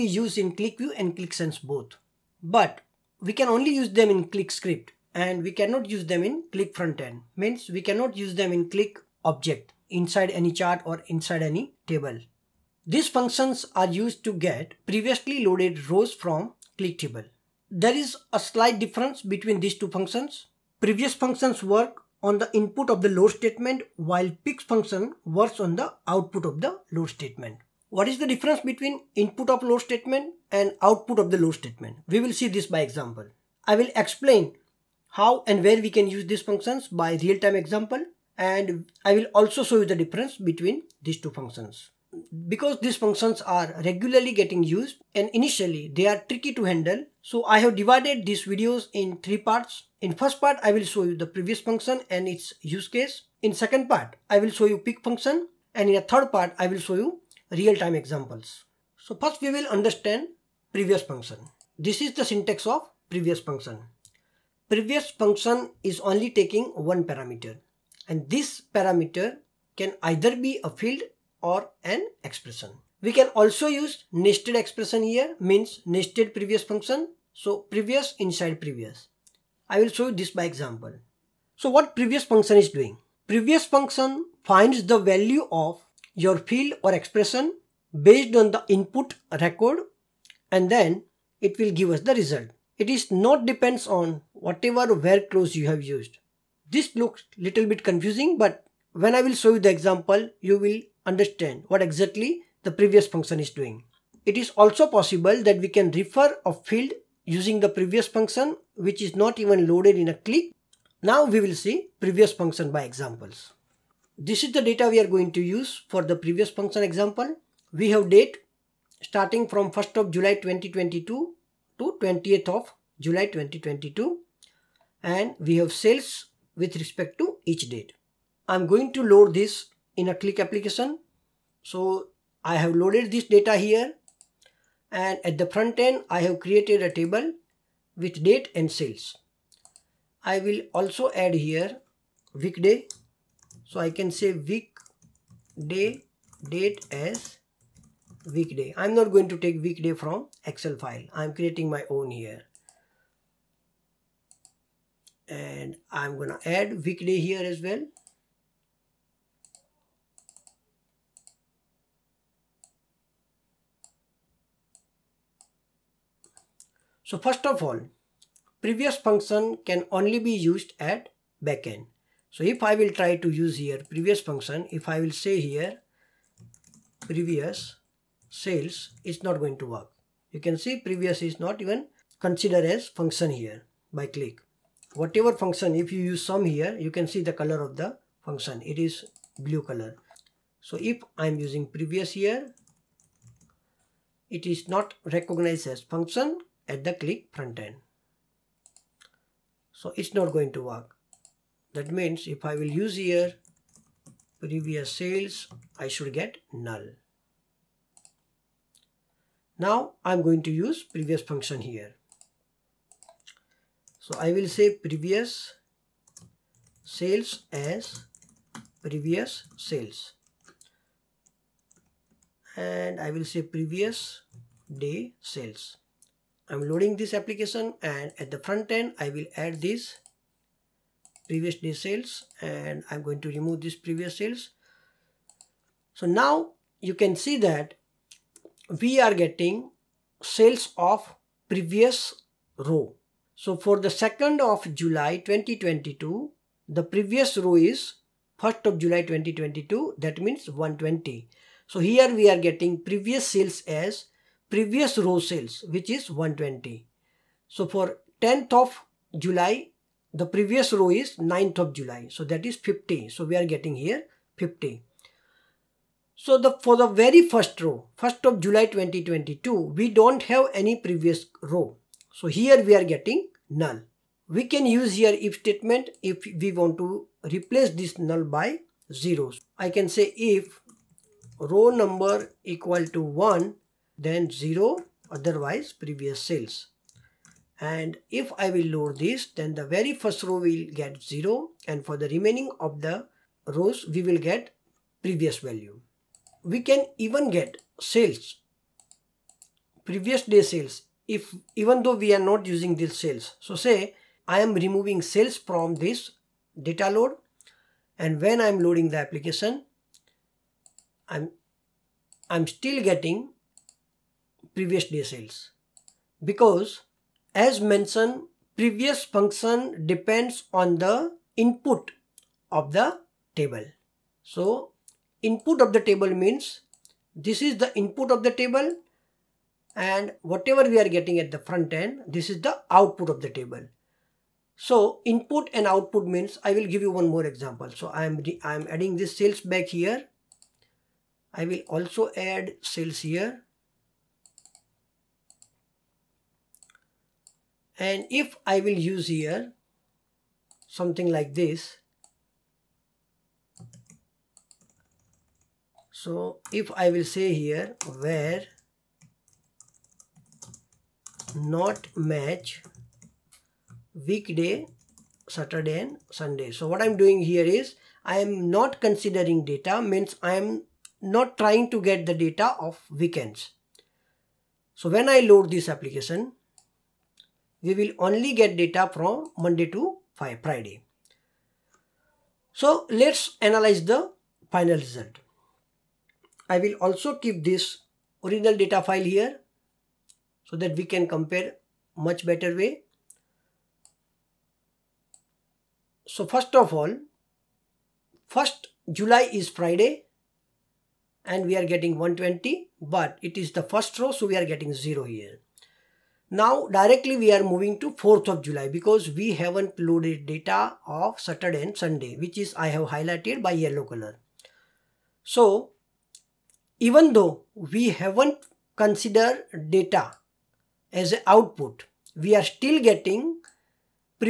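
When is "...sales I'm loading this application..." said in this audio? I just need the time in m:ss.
3:45.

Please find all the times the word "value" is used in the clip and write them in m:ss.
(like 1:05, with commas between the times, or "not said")
1:24, 4:55.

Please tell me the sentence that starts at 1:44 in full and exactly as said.
It is also possible that we can refer a field using the previous function which is not even loaded in a Qlik.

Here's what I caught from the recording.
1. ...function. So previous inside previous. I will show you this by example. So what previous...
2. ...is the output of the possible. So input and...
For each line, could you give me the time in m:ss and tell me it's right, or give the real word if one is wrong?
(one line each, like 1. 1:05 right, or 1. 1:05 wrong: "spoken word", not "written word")
1. 1:16 right
2. 5:32 wrong: "table", not "possible".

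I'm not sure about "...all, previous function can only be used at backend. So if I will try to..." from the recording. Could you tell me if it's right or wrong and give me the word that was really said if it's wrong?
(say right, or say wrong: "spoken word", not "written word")
right.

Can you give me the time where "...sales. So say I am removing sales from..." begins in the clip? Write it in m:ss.
5:02.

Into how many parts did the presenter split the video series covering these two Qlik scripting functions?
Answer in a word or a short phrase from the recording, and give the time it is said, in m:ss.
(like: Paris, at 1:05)
3, at 0:49.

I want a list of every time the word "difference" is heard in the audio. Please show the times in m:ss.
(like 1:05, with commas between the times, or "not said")
0:18, 0:28, 0:39.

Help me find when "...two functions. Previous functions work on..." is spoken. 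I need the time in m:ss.
0:19.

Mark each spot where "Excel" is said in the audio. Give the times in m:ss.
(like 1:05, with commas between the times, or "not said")
2:30.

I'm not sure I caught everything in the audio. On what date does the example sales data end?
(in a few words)
20th of July 2022.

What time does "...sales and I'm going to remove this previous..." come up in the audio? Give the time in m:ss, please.
3:51.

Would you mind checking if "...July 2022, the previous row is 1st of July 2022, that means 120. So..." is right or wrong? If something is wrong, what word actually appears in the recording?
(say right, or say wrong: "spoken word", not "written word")
right.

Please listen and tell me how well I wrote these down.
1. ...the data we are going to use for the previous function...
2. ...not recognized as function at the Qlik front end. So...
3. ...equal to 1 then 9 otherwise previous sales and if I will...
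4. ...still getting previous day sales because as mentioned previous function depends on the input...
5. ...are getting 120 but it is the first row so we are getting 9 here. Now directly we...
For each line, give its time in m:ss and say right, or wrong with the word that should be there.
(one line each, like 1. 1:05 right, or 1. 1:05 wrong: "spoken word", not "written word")
1. 1:54 right
2. 3:14 right
3. 4:42 wrong: "0", not "9"
4. 5:12 right
5. 6:41 wrong: "0", not "9".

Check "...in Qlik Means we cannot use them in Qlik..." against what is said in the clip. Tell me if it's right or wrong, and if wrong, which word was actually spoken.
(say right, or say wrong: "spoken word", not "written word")
right.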